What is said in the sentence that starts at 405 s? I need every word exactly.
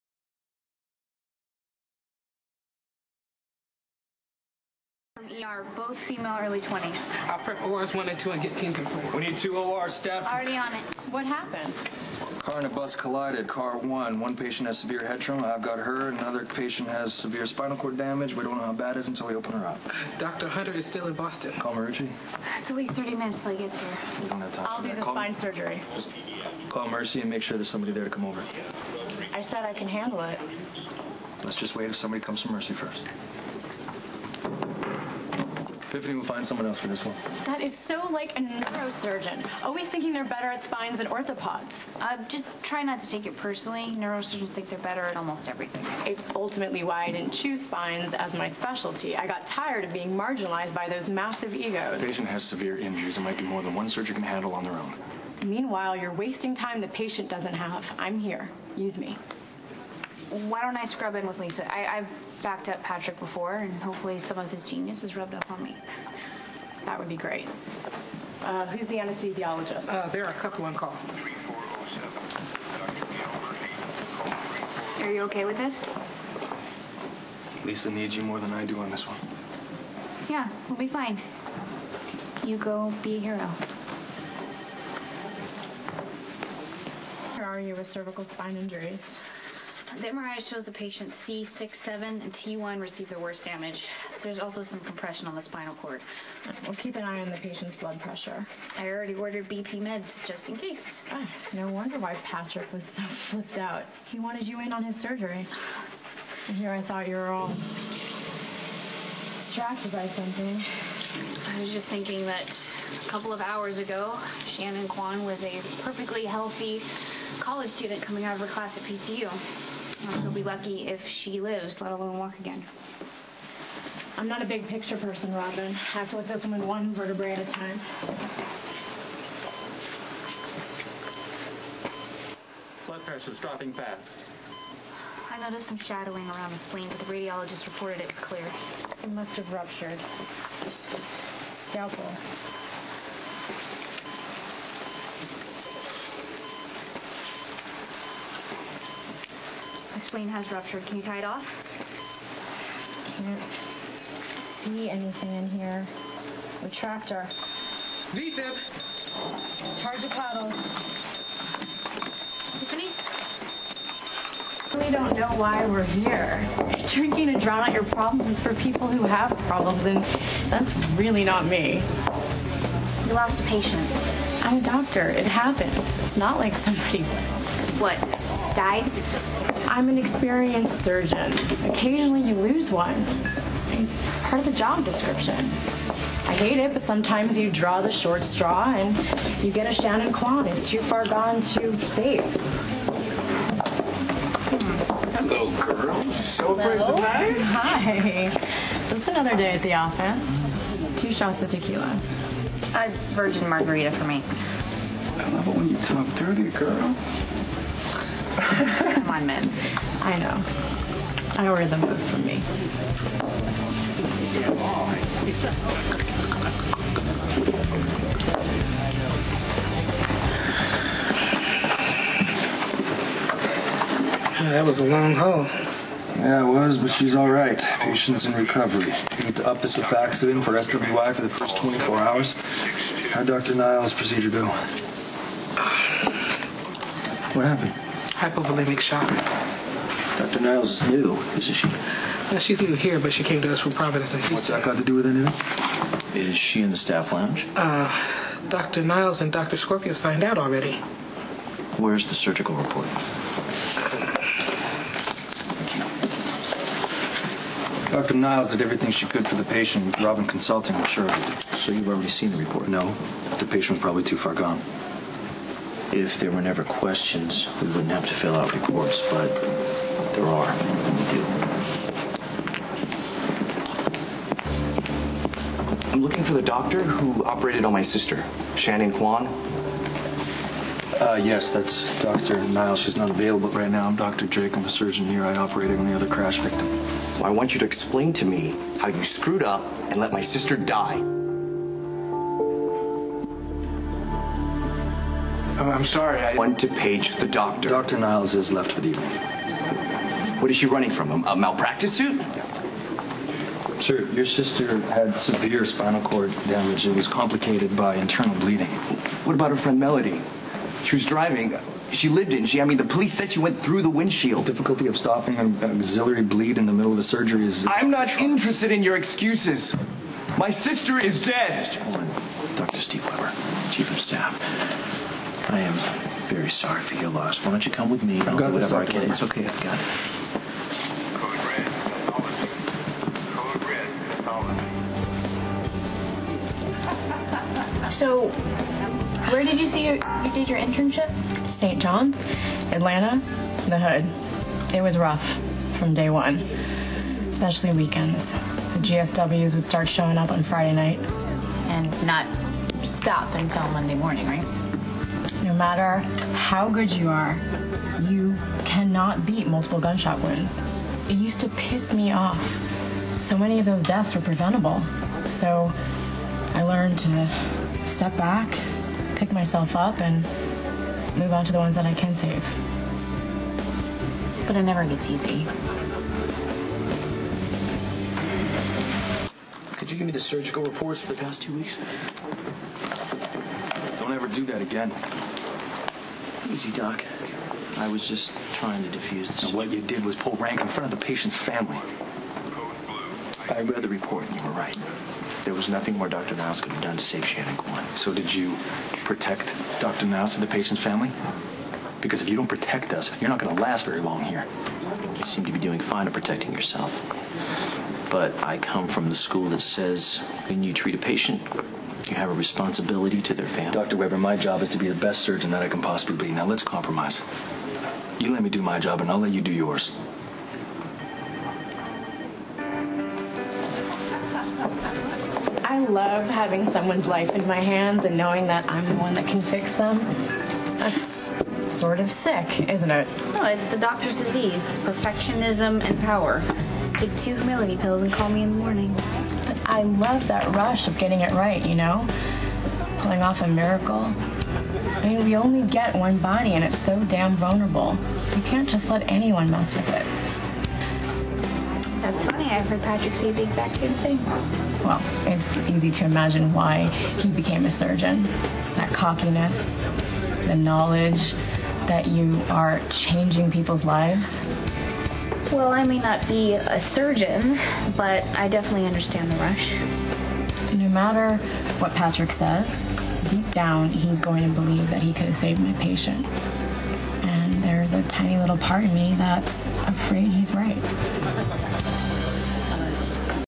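You seem to be doing fine at protecting yourself.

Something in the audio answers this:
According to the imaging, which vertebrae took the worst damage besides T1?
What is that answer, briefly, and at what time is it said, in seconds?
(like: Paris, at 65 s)
C6-7, at 91 s.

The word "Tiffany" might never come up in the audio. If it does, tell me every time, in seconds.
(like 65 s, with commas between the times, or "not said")
162 s.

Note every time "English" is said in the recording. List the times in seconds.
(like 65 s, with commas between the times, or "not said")
not said.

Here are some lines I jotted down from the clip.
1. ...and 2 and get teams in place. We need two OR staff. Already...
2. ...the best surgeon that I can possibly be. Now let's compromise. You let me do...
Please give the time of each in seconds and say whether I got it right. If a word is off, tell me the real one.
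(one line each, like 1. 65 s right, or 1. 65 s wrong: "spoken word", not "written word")
1. 8 s right
2. 414 s right.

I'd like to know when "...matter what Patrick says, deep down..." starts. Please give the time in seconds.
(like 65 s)
470 s.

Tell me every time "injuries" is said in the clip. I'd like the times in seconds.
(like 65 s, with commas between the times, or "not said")
52 s, 88 s.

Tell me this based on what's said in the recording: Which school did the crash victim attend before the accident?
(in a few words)
PCU.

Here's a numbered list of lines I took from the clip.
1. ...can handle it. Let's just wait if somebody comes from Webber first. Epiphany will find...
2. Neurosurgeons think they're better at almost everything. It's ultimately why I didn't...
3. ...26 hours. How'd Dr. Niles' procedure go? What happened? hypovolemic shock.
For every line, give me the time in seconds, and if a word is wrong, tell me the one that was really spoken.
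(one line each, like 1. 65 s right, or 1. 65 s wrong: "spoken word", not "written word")
1. 29 s wrong: "Mercy", not "Webber"
2. 43 s right
3. 231 s wrong: "24", not "26".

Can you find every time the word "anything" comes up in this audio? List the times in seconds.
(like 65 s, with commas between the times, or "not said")
154 s, 245 s.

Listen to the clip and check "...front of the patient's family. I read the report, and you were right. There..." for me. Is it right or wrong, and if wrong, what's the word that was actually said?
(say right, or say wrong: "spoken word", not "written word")
right.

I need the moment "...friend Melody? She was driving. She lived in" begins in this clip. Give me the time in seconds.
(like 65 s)
309 s.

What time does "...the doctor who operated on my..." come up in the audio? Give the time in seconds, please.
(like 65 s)
276 s.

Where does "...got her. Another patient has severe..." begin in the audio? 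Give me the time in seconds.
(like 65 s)
15 s.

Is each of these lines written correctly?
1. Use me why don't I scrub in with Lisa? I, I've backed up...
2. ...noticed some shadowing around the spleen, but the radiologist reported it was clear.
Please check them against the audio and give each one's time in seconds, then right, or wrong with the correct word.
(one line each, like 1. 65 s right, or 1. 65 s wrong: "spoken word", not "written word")
1. 58 s right
2. 135 s right.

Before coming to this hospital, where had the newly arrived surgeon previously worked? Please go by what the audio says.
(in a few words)
Providence.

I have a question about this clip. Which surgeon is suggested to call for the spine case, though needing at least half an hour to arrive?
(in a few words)
Marucci.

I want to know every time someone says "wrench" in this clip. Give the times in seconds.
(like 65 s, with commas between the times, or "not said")
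not said.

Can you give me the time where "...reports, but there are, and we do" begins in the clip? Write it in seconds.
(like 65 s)
268 s.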